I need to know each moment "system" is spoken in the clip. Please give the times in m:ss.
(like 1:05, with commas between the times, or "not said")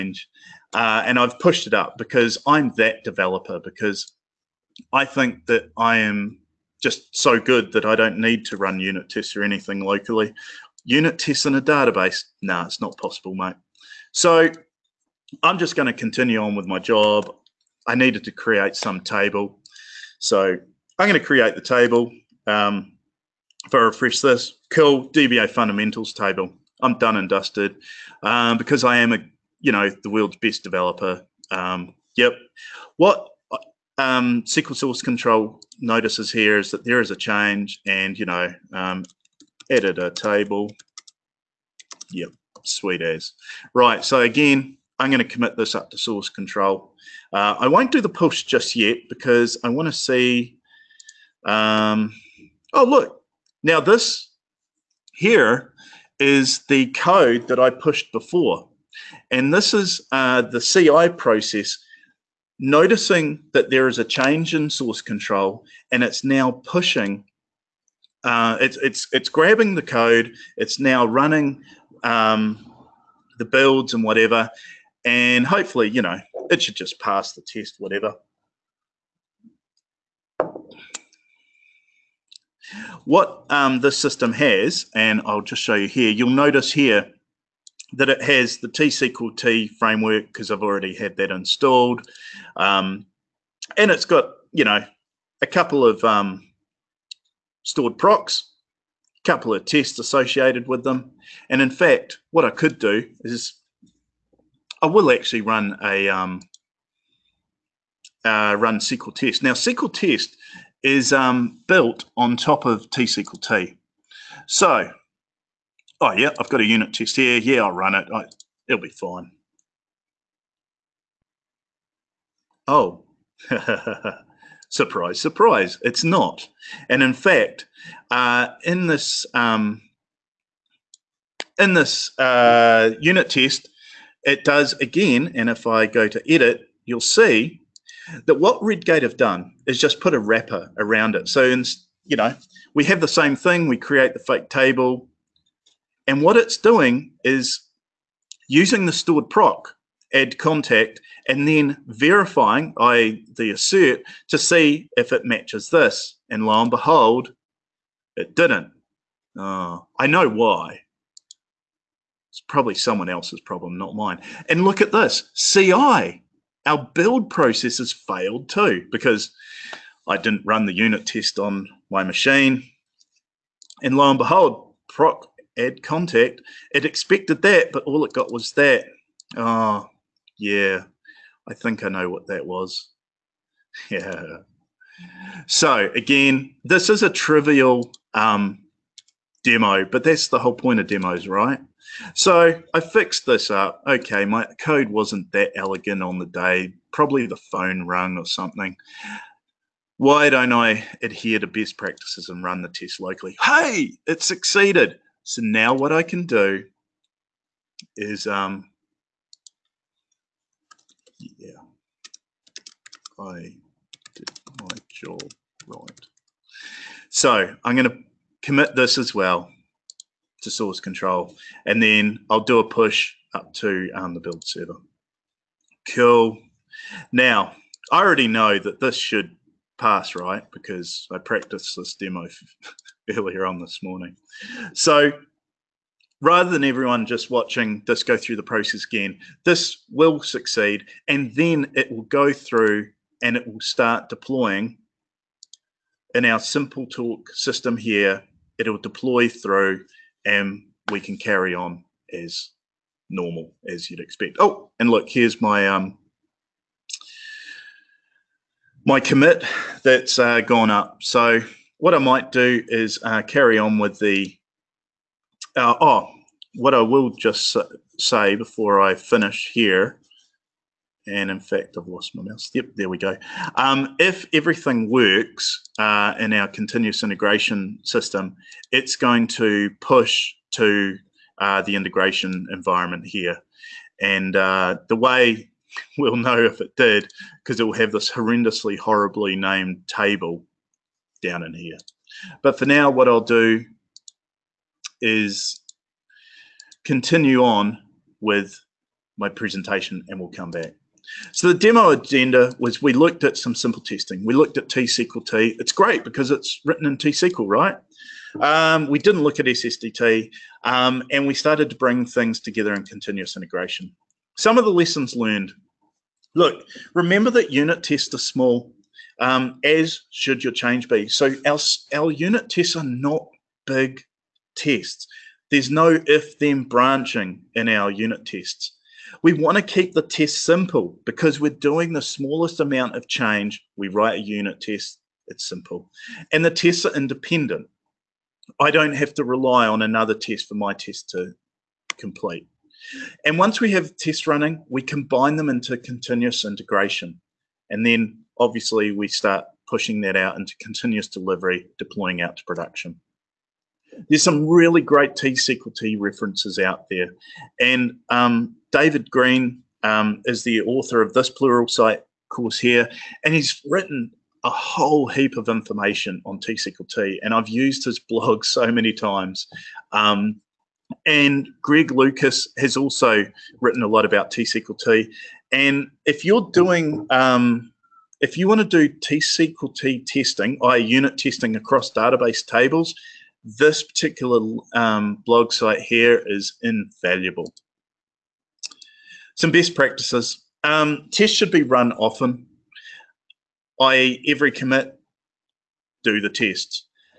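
1:23, 4:07, 4:37.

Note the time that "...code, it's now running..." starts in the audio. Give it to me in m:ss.
1:09.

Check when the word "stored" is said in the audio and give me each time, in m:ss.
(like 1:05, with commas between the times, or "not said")
1:37, 2:28.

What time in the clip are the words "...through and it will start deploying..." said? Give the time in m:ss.
4:02.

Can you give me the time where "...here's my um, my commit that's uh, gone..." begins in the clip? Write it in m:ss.
4:15.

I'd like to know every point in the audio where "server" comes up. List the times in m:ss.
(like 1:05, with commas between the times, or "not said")
3:44.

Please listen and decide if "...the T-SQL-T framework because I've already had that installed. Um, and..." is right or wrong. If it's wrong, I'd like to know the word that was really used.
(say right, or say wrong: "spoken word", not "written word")
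right.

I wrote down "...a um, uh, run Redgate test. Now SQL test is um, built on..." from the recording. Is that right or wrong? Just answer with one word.
wrong.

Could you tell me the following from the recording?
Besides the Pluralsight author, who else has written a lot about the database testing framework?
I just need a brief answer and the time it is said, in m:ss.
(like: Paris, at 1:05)
Greg Lucas, at 6:11.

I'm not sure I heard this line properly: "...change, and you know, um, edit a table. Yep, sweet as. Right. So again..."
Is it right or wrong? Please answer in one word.
right.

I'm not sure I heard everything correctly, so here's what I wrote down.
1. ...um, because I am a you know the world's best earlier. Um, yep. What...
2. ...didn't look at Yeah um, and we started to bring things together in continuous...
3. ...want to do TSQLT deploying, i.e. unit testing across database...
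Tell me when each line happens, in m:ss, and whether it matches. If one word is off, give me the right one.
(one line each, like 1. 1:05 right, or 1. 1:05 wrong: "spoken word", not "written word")
1. 0:28 wrong: "developer", not "earlier"
2. 5:08 wrong: "SSDT", not "Yeah"
3. 6:18 wrong: "testing", not "deploying".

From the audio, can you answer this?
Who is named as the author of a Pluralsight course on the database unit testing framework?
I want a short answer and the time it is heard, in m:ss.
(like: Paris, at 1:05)
David Green, at 5:58.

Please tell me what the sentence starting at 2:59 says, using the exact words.
Oh, yeah, I think I know what that was.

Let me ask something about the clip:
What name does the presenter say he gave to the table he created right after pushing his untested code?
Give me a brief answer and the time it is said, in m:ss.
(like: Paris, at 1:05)
DBA fundamentals table, at 0:25.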